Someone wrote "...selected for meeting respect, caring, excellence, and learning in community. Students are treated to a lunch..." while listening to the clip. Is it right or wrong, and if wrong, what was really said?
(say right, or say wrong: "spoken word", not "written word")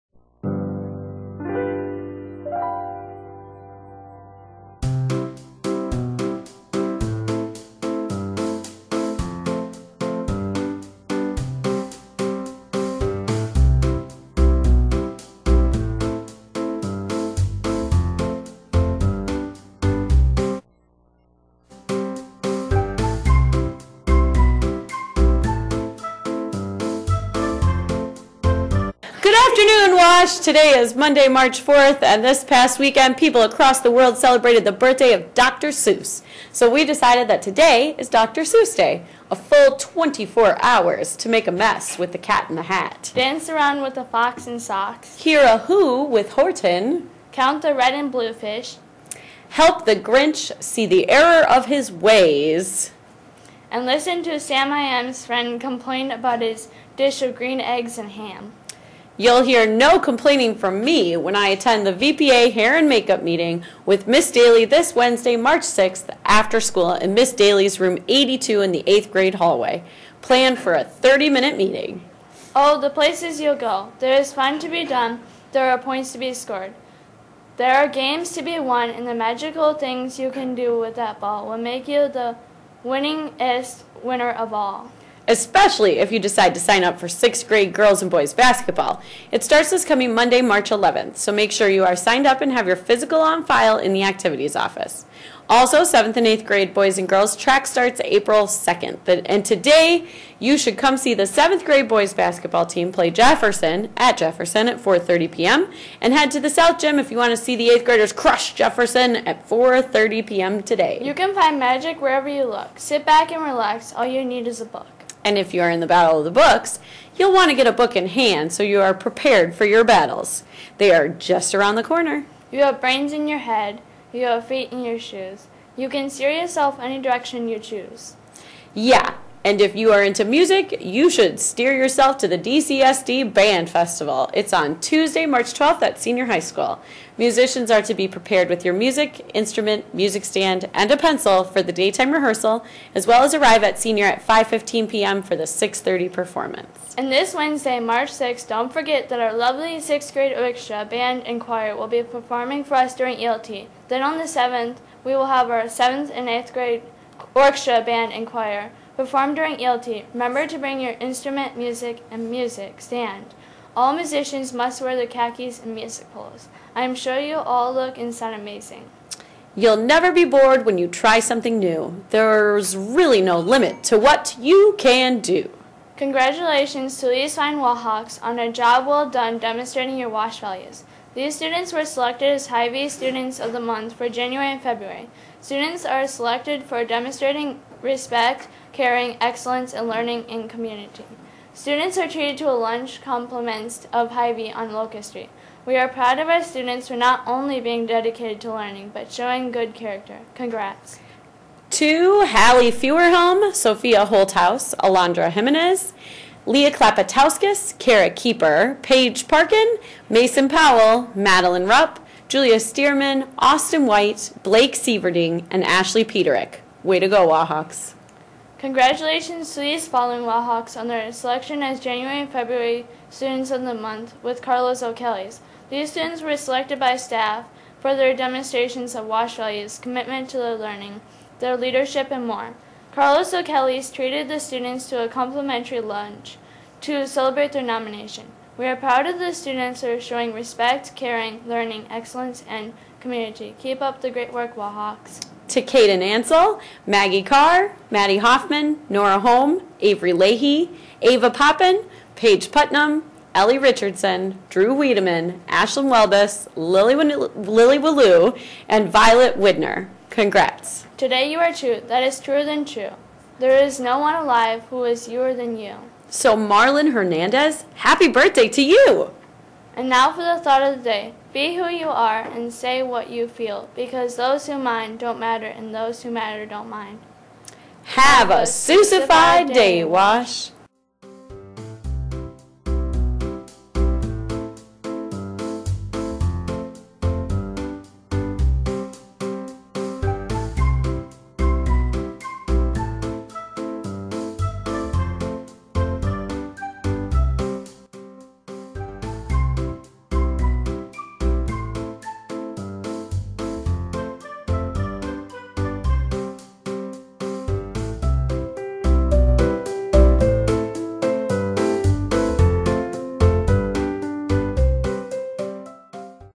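wrong: "demonstrating", not "meeting".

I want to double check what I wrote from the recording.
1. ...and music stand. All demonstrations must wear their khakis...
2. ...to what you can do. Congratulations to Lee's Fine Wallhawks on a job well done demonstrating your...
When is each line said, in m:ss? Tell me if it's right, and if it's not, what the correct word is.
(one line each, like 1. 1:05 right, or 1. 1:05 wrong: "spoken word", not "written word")
1. 2:42 wrong: "musicians", not "demonstrations"
2. 2:53 right.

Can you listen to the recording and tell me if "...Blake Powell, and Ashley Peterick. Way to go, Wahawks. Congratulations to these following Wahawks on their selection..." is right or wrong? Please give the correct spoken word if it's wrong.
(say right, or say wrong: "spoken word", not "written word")
wrong: "Sieverding", not "Powell".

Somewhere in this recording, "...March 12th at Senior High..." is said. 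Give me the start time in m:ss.
2:15.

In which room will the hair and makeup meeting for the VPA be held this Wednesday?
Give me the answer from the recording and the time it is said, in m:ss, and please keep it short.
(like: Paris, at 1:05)
Room 82, at 1:07.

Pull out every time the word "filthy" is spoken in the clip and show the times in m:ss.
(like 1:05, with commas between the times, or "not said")
not said.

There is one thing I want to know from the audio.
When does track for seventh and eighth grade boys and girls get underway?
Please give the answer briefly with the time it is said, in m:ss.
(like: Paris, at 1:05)
April 2nd, at 1:38.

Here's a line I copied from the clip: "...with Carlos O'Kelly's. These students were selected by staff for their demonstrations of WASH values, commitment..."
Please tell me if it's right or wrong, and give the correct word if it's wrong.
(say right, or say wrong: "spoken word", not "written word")
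right.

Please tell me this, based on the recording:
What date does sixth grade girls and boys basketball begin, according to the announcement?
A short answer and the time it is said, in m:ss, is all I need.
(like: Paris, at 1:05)
March 11th, at 1:30.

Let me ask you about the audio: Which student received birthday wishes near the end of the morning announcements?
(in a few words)
Marlon Hernandez.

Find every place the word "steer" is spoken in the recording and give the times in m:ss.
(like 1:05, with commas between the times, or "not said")
2:06, 2:11.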